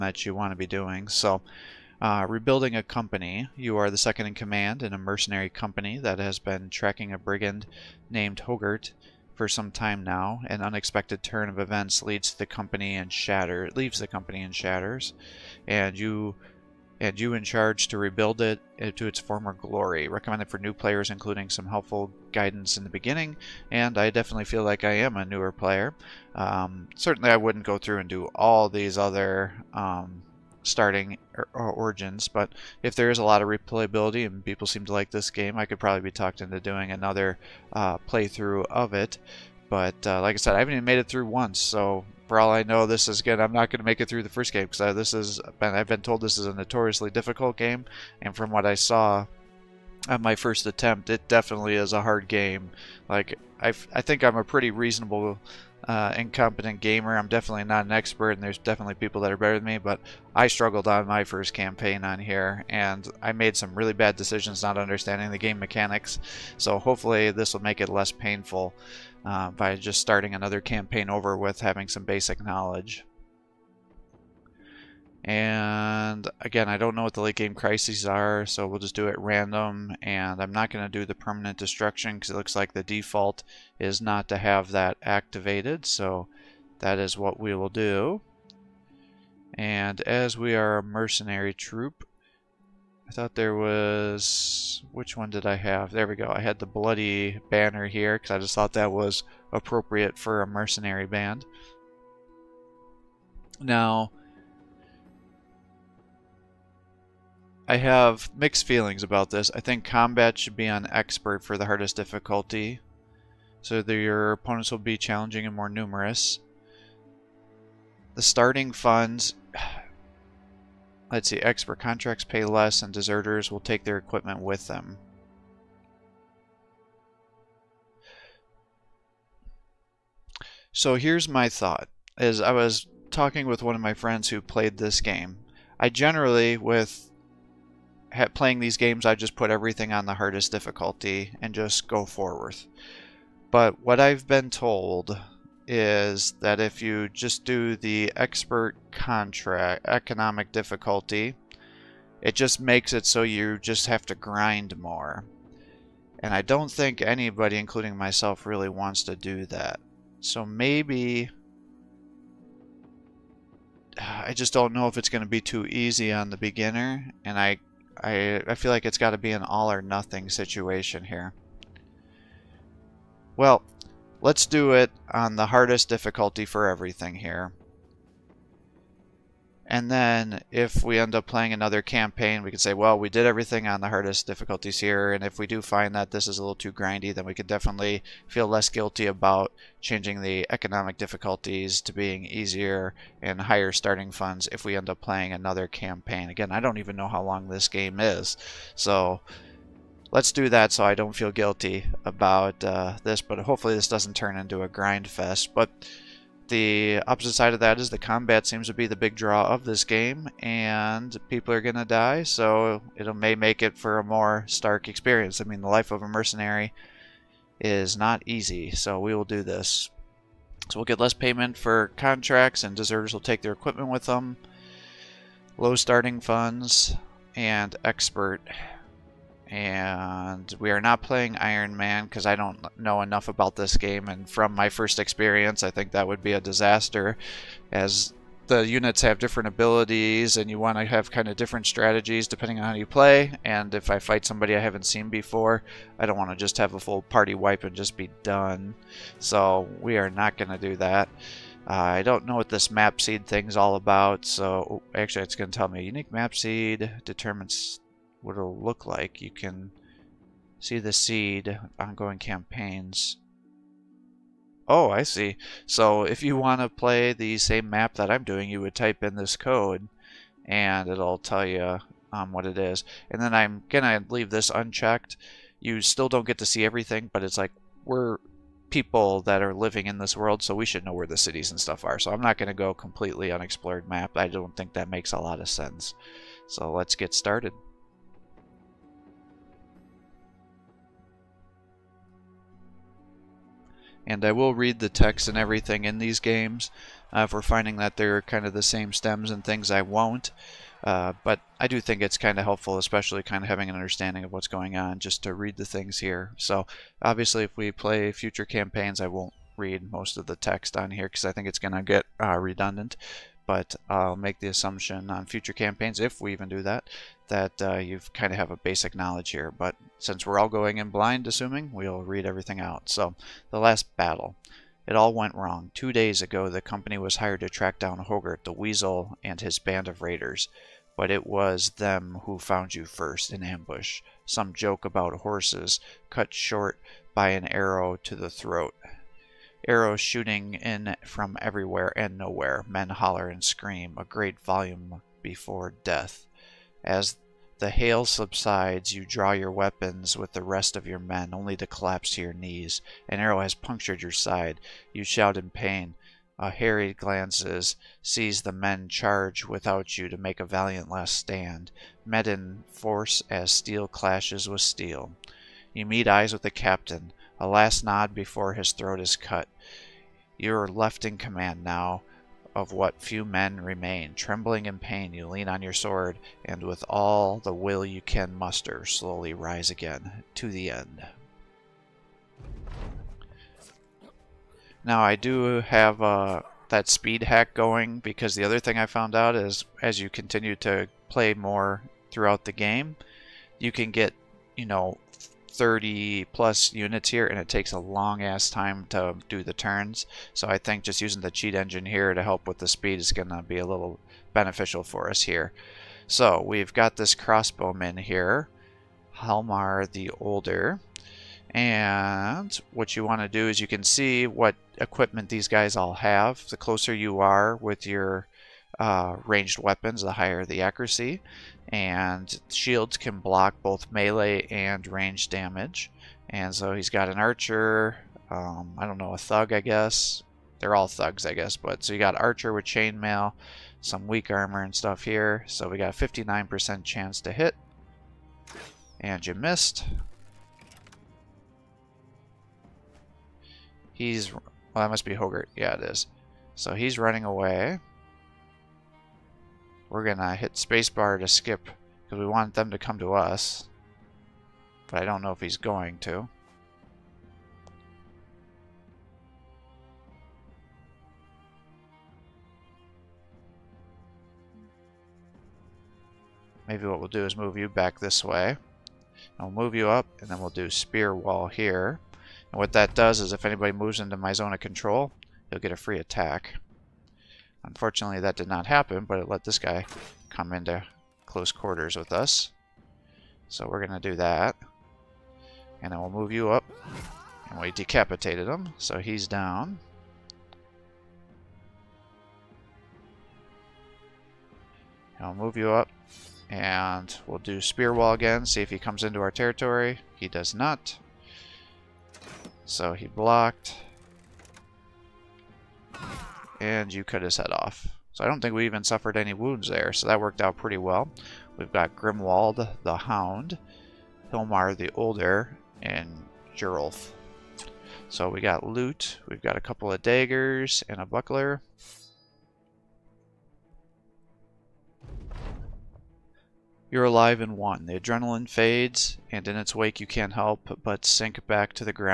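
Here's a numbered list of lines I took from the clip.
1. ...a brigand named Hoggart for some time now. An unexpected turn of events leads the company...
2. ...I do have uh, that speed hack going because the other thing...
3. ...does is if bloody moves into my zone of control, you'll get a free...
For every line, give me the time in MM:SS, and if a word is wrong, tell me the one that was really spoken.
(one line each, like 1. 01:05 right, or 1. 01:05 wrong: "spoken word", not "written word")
1. 00:07 right
2. 06:25 right
3. 07:52 wrong: "anybody", not "bloody".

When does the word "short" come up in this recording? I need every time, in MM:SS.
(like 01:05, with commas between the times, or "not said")
05:36.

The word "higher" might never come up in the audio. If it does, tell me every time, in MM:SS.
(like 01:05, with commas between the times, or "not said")
03:13, 07:00.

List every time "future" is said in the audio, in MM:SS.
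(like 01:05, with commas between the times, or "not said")
05:08, 05:15.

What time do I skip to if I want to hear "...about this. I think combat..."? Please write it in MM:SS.
01:49.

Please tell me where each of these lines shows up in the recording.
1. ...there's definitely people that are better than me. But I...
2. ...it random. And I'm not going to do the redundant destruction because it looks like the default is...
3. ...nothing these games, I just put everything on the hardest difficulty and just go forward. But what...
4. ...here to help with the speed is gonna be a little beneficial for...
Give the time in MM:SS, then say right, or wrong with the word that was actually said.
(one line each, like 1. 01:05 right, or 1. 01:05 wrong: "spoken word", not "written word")
1. 00:58 right
2. 01:19 wrong: "permanent", not "redundant"
3. 02:18 wrong: "playing", not "nothing"
4. 06:41 right.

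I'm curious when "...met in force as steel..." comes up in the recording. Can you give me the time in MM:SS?
06:02.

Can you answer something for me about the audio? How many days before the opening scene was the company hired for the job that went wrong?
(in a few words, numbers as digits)
2.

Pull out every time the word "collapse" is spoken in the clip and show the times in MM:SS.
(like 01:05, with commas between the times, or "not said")
05:51.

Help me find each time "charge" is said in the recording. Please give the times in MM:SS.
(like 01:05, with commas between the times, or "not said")
00:17, 05:58.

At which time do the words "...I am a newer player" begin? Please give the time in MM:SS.
00:24.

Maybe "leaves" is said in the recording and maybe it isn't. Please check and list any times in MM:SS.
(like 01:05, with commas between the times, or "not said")
00:13, 04:34.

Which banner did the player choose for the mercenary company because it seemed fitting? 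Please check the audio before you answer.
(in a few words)
the bloody banner.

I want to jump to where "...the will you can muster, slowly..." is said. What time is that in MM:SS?
06:17.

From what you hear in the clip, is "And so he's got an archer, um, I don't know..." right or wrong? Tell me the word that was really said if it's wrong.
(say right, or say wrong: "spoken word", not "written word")
right.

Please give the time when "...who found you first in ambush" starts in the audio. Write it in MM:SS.
05:32.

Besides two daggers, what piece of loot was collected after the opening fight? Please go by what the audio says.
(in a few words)
a buckler.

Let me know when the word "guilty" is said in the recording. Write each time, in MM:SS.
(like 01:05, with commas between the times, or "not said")
03:08, 03:21.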